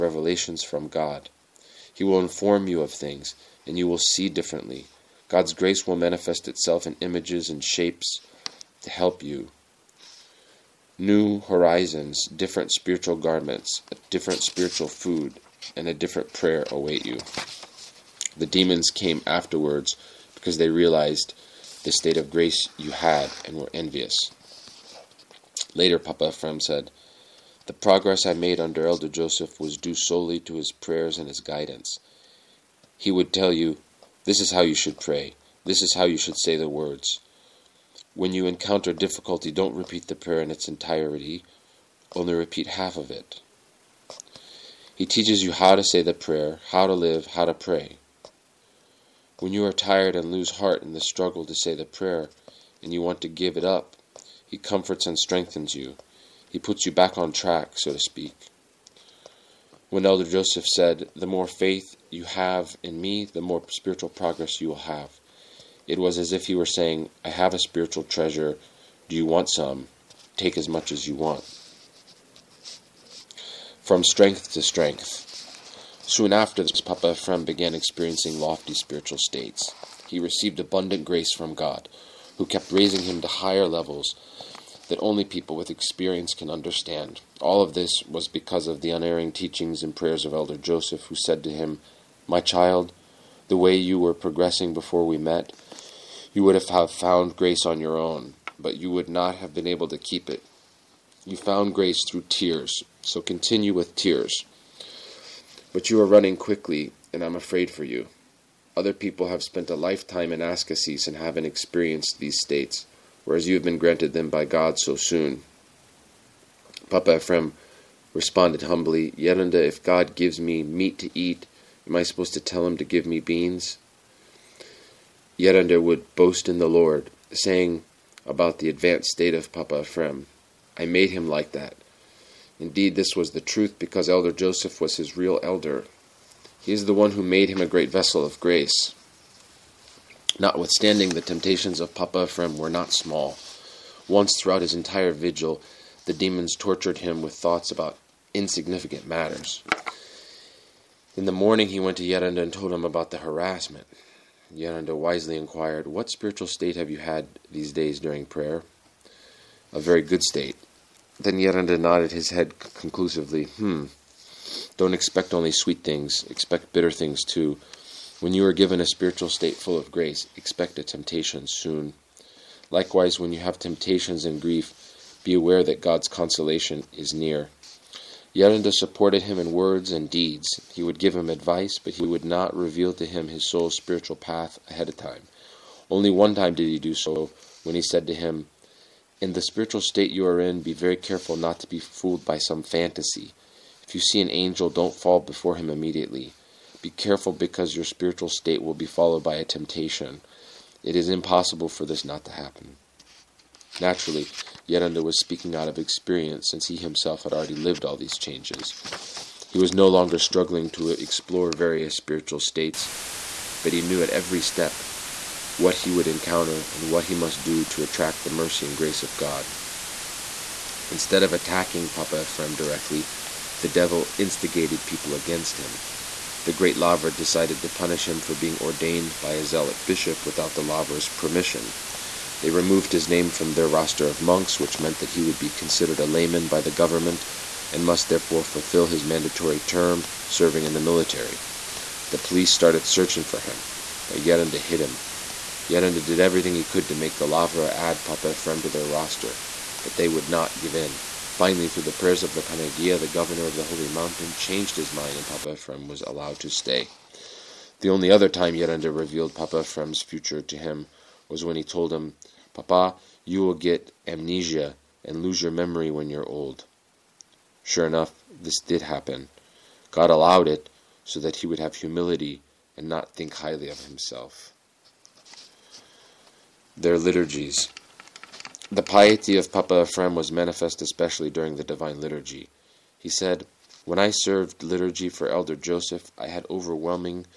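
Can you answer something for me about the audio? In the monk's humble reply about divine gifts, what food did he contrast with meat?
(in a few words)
Beans.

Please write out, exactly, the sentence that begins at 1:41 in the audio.
You found grace through tears, so continue with tears.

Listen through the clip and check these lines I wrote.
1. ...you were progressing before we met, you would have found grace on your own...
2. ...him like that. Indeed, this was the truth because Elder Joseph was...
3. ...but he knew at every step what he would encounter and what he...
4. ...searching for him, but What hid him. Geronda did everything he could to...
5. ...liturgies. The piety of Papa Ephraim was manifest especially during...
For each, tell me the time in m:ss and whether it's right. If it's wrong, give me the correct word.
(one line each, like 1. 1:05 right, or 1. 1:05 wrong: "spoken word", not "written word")
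1. 1:33 right
2. 2:11 right
3. 3:33 right
4. 4:02 wrong: "Geronda", not "What"
5. 4:36 right.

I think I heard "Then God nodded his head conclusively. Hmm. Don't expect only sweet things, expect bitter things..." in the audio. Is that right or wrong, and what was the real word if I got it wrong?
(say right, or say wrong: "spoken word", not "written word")
wrong: "Geronda", not "God".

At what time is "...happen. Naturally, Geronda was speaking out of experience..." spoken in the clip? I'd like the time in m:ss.
3:22.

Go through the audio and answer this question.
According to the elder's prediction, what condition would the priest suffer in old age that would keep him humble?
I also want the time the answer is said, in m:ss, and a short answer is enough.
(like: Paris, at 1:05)
Amnesia, at 4:24.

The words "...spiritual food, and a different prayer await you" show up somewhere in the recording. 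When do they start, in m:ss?
0:14.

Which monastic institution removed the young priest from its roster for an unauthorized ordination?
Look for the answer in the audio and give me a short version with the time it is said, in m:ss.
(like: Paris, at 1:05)
Great Lavra, at 3:46.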